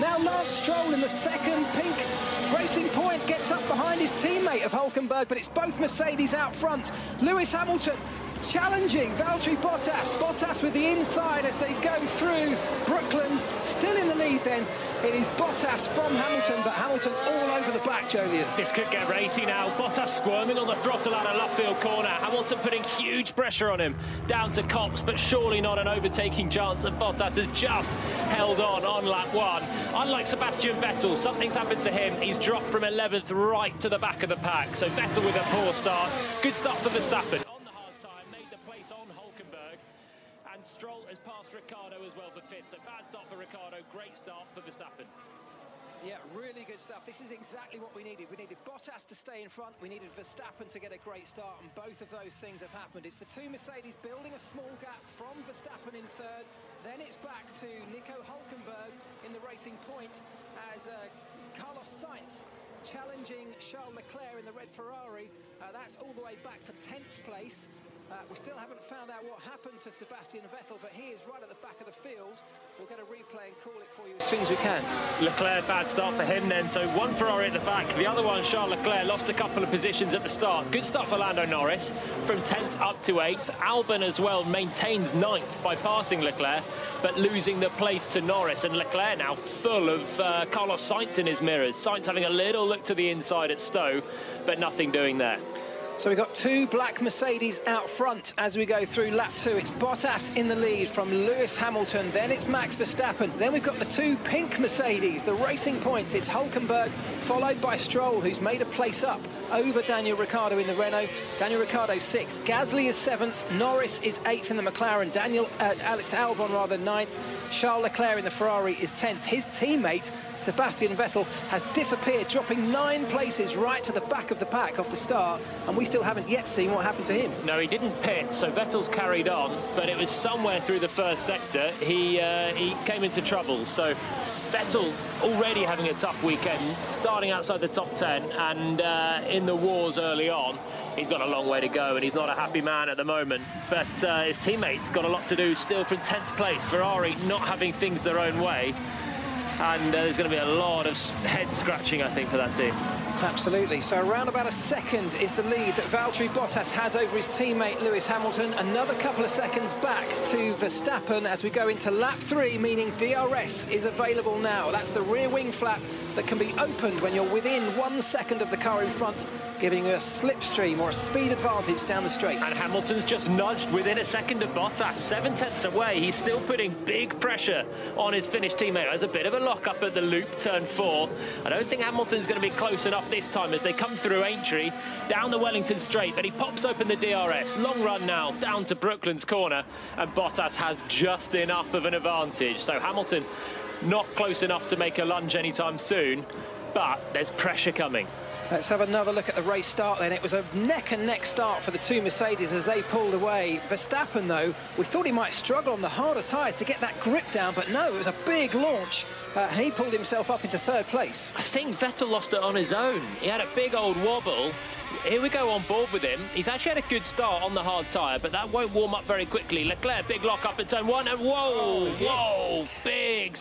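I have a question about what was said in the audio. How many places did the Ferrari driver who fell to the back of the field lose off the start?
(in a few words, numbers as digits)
9.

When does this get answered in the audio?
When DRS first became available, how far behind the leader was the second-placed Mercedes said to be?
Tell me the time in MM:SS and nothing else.
02:54.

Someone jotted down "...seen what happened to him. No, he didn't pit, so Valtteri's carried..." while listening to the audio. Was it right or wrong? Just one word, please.
wrong.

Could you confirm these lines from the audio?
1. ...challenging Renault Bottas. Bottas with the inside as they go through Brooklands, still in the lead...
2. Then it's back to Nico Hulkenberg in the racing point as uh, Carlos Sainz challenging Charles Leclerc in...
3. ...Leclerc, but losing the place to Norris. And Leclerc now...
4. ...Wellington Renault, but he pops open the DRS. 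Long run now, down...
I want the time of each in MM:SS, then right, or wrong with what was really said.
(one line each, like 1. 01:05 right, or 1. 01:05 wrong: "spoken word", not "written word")
1. 00:08 wrong: "Valtteri", not "Renault"
2. 00:56 right
3. 01:26 right
4. 03:05 wrong: "Straight", not "Renault".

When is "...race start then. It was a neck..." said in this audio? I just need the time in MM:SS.
03:19.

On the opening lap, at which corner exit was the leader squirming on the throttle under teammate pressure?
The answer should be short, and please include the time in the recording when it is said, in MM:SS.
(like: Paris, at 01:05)
Luffield, at 00:21.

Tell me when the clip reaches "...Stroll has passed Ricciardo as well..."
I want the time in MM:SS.
00:40.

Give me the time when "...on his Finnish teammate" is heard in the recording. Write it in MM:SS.
02:57.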